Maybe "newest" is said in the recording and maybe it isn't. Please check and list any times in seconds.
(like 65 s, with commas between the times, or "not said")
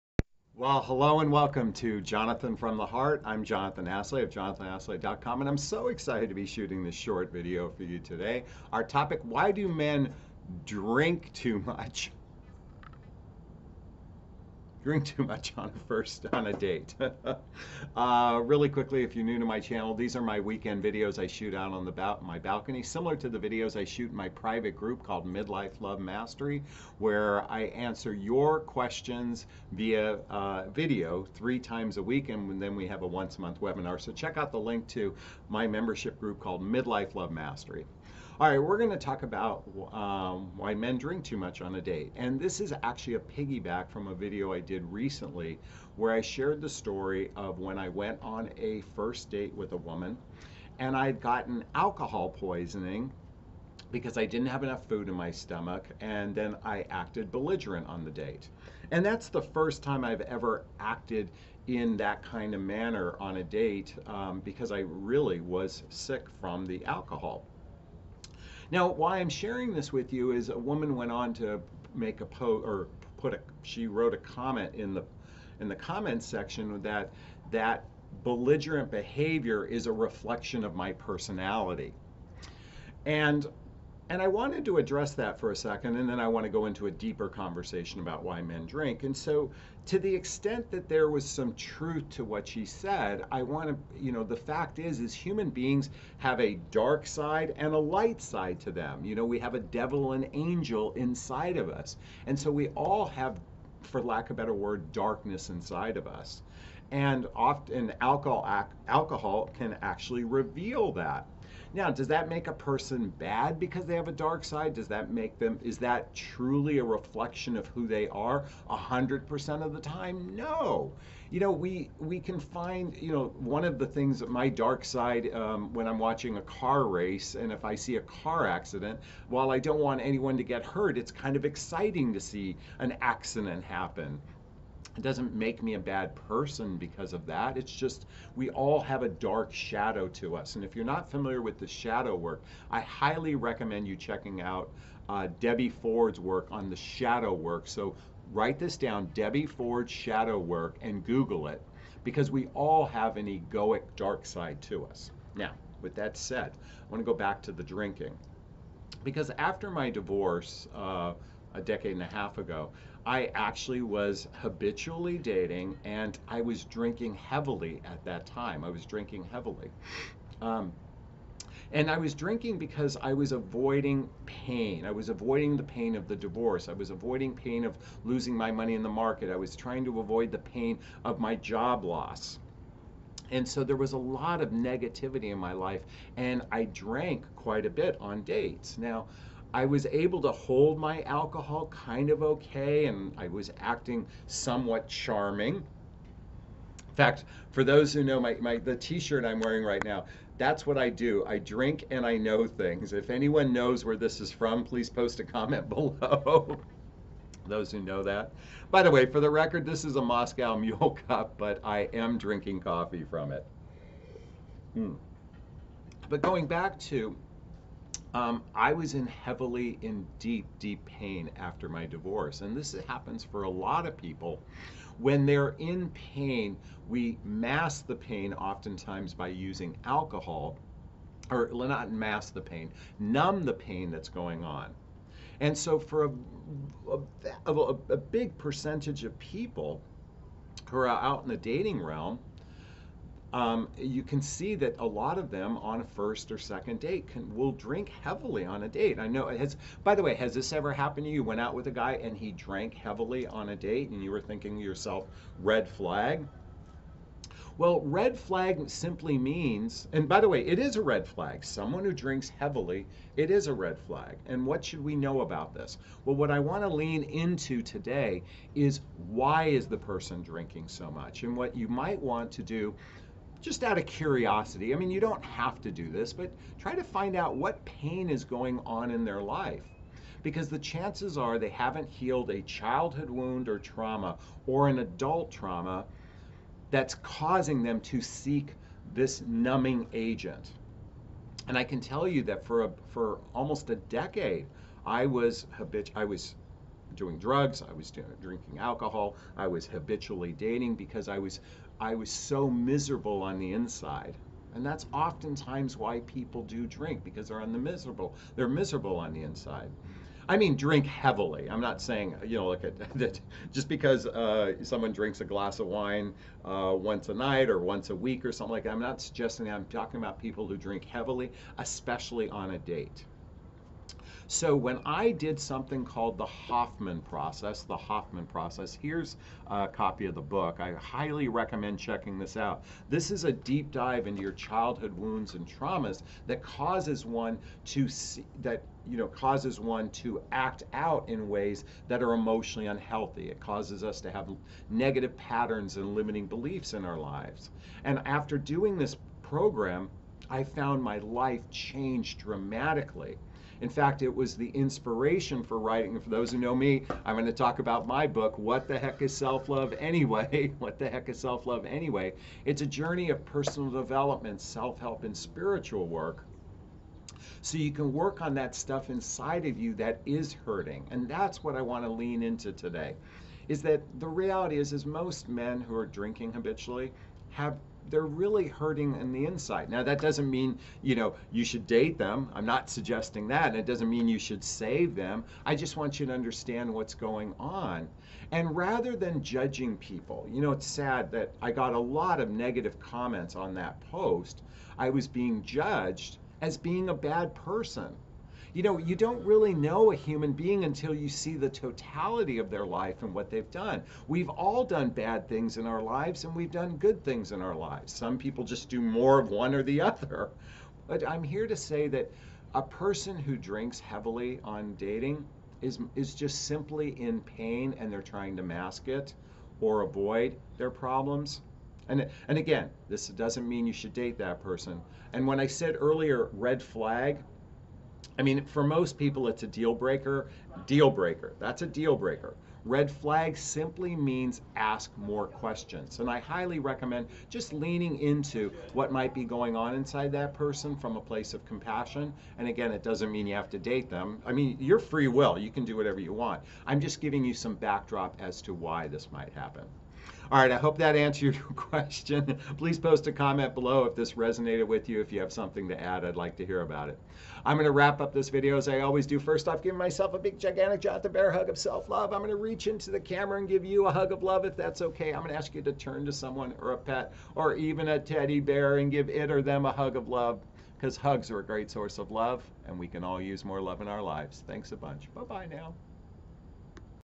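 not said.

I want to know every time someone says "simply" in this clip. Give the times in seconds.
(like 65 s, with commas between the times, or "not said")
258 s, 416 s, 433 s.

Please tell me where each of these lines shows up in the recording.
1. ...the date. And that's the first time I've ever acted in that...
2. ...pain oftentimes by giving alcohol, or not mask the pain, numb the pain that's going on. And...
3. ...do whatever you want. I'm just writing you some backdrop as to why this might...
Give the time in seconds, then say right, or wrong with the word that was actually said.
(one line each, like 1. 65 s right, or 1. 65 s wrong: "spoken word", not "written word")
1. 58 s right
2. 227 s wrong: "using", not "giving"
3. 445 s wrong: "giving", not "writing".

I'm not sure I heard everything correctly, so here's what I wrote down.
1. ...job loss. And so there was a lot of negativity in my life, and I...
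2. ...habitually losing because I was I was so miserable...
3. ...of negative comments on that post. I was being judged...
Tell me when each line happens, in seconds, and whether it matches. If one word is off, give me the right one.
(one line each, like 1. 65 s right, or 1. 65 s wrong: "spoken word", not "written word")
1. 181 s right
2. 299 s wrong: "dating", not "losing"
3. 392 s right.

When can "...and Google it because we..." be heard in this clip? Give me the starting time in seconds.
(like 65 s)
150 s.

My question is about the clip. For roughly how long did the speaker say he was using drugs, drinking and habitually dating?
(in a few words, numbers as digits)
almost a decade.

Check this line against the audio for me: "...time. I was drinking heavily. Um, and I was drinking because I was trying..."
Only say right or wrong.
wrong.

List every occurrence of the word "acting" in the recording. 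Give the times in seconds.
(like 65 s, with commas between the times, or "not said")
193 s.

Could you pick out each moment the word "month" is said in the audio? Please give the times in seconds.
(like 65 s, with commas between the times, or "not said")
33 s.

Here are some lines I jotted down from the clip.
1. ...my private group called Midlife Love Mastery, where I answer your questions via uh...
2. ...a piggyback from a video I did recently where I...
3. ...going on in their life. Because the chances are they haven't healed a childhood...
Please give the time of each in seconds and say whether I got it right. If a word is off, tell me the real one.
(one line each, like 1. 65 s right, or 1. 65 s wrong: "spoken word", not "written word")
1. 24 s right
2. 43 s right
3. 278 s right.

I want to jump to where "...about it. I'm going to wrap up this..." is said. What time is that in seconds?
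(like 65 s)
456 s.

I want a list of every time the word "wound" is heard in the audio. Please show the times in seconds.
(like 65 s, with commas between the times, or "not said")
283 s, 334 s.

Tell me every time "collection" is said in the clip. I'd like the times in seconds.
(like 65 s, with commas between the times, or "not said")
not said.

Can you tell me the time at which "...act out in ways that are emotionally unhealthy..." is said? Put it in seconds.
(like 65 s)
340 s.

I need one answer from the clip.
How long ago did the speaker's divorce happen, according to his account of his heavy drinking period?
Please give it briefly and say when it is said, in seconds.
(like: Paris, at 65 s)
a decade and a half, at 161 s.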